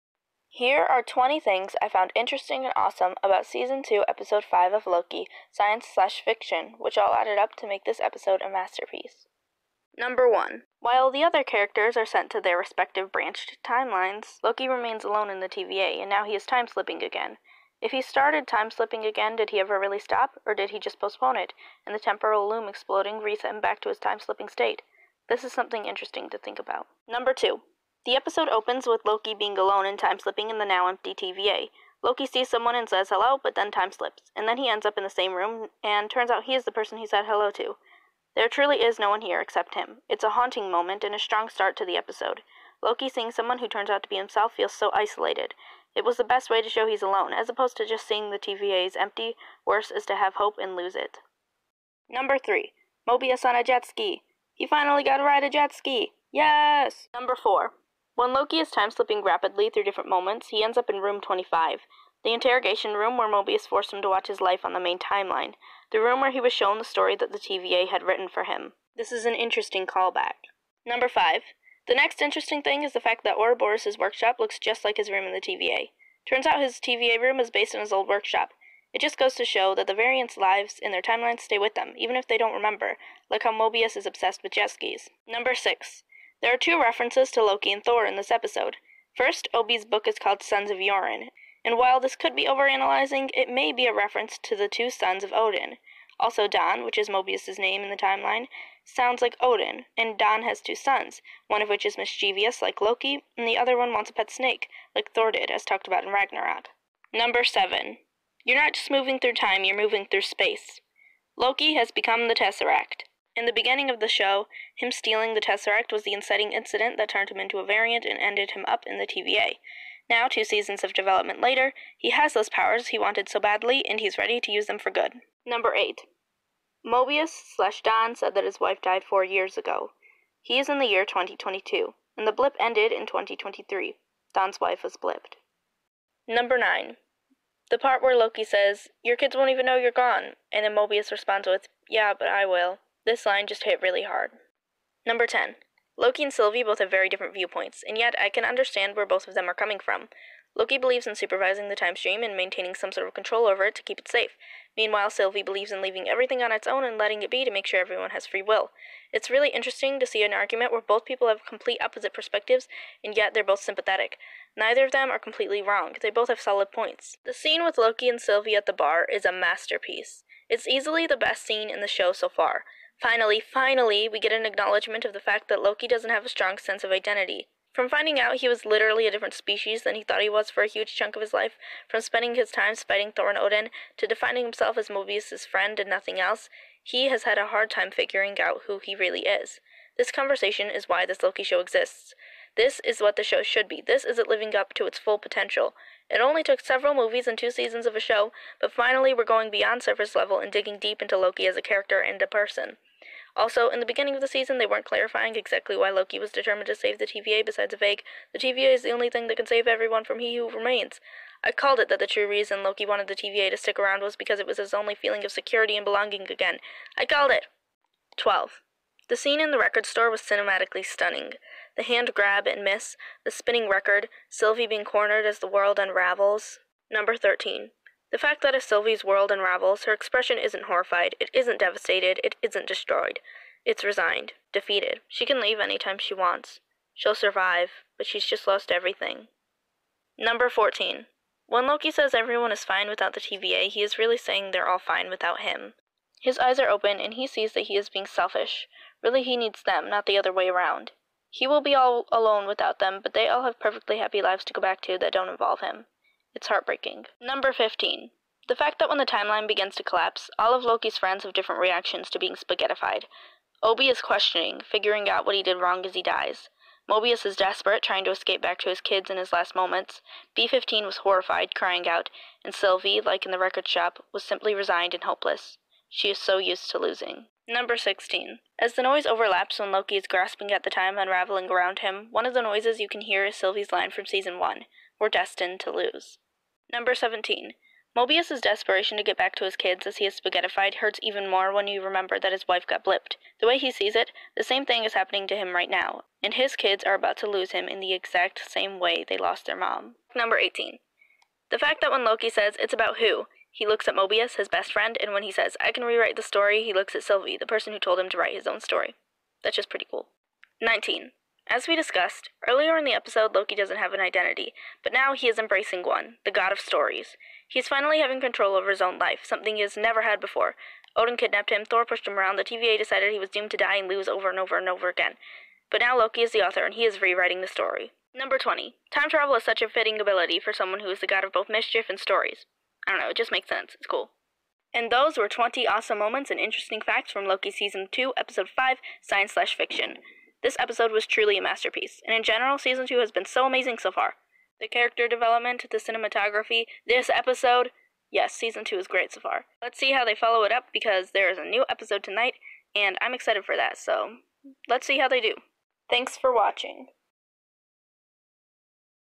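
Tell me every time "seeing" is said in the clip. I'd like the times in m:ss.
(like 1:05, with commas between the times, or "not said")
0:43, 0:48.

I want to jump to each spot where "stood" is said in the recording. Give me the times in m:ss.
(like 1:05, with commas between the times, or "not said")
not said.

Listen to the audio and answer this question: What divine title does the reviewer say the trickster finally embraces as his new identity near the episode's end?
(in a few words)
God of stories.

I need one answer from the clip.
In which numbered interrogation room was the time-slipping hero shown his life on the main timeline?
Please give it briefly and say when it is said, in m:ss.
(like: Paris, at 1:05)
Room 25, at 1:00.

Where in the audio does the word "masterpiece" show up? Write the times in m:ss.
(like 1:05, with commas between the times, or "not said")
0:08, 2:49, 5:41.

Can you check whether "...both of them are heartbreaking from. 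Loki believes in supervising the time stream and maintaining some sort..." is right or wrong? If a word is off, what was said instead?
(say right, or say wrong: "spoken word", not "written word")
wrong: "coming", not "heartbreaking".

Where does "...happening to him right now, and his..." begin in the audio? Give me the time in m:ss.
4:54.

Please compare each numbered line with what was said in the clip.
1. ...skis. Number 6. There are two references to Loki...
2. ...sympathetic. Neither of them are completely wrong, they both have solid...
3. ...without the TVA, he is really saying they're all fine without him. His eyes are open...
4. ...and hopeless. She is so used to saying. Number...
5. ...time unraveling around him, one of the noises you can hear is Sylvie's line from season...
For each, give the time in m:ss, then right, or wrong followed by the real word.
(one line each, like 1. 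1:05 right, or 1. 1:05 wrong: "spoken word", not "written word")
1. 1:24 right
2. 2:43 right
3. 4:02 right
4. 4:34 wrong: "losing", not "saying"
5. 4:40 right.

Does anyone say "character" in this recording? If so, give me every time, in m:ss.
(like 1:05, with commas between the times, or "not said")
0:11, 3:21, 5:44.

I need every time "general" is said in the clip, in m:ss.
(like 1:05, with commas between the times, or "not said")
5:42.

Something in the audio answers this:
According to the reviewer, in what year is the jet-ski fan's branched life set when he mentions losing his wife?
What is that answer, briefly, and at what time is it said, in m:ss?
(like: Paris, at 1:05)
2022, at 2:11.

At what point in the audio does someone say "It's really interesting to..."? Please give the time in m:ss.
2:39.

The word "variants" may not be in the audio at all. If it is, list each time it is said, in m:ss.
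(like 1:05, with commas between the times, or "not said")
1:19, 1:57.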